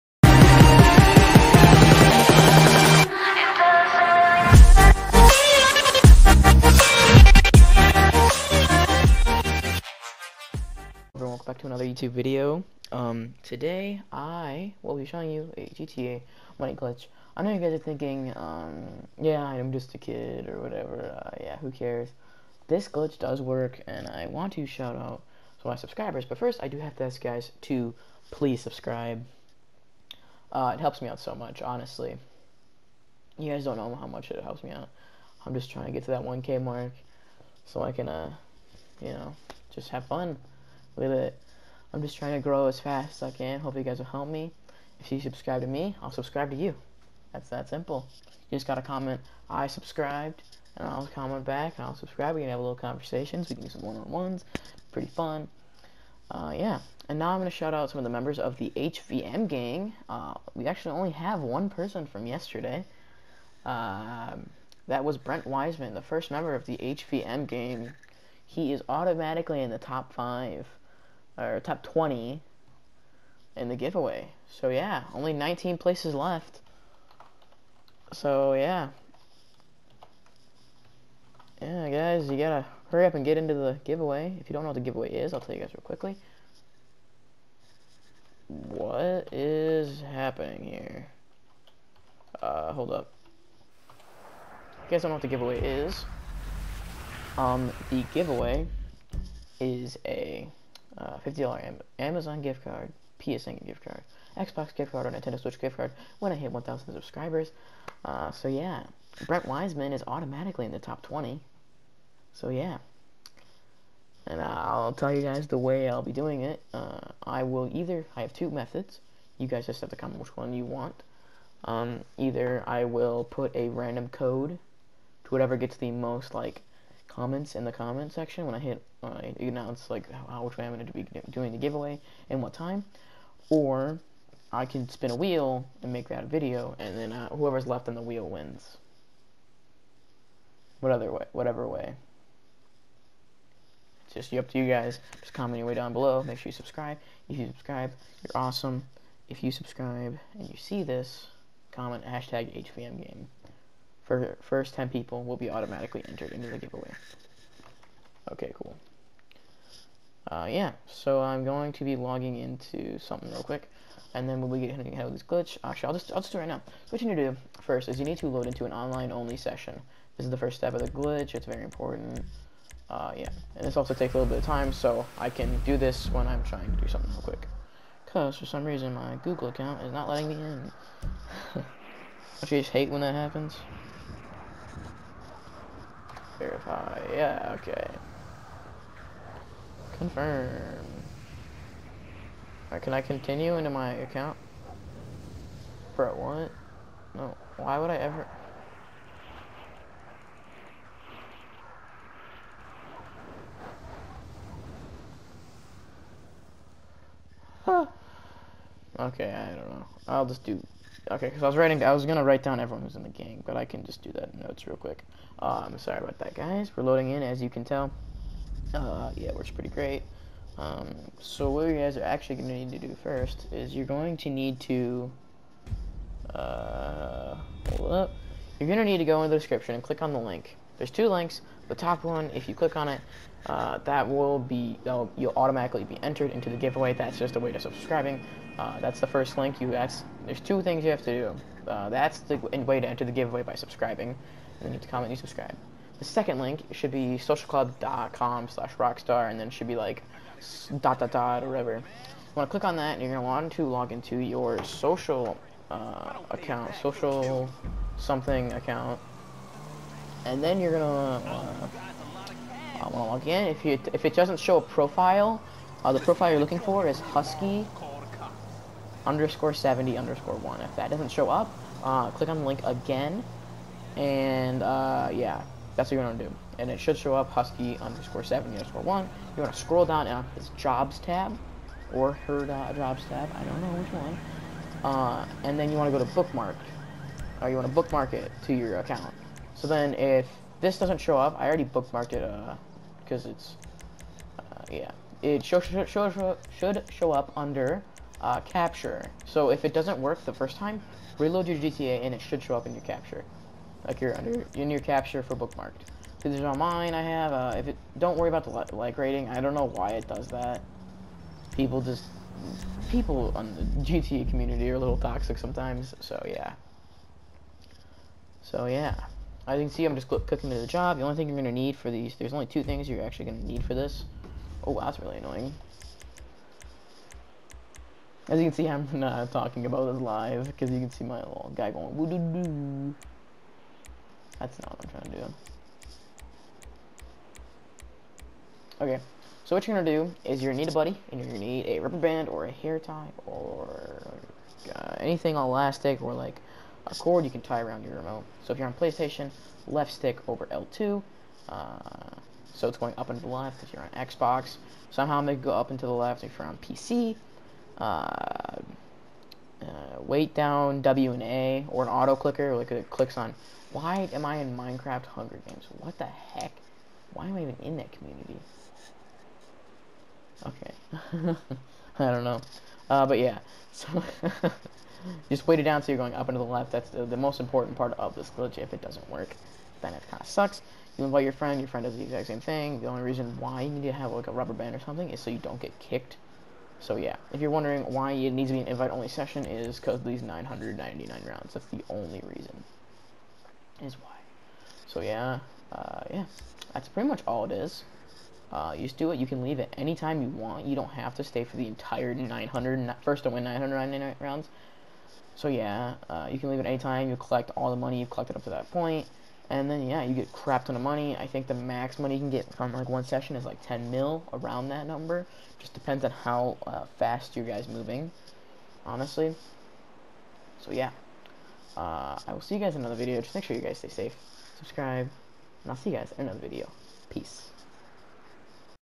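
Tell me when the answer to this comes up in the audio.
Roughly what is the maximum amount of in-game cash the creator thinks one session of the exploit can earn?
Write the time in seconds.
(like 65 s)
413 s.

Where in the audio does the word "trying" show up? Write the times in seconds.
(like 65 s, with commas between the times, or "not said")
35 s, 42 s, 176 s, 334 s.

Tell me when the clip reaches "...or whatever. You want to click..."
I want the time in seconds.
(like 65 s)
251 s.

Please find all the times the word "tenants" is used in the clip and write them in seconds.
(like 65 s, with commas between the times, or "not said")
not said.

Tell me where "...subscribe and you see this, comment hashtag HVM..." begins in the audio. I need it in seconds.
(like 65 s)
149 s.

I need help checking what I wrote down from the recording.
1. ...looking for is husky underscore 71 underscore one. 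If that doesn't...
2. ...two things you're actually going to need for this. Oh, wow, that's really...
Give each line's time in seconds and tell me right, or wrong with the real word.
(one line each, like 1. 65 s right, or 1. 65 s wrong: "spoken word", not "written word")
1. 266 s wrong: "70", not "71"
2. 322 s right.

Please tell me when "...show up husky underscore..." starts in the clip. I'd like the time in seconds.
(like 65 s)
276 s.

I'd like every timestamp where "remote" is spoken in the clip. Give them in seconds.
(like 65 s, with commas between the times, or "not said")
347 s.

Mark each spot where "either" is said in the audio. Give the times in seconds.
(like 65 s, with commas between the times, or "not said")
117 s, 122 s.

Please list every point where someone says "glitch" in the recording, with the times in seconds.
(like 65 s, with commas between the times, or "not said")
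16 s, 22 s, 165 s, 170 s, 378 s.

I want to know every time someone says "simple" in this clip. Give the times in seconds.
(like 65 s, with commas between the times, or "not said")
47 s.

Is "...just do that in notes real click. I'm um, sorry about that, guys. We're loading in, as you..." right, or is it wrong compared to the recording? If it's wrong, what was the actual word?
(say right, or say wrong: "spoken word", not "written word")
wrong: "quick", not "click".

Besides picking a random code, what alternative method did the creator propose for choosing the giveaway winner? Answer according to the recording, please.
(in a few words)
spin a wheel.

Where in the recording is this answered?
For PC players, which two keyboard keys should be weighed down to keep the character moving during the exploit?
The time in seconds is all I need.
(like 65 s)
360 s.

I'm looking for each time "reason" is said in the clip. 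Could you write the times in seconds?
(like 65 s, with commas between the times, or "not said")
178 s, 383 s, 392 s.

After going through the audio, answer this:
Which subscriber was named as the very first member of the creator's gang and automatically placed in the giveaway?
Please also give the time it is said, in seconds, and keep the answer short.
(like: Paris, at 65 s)
Brent Wiseman, at 65 s.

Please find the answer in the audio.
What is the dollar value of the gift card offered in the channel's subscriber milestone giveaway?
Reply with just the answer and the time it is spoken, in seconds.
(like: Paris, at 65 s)
$50, at 101 s.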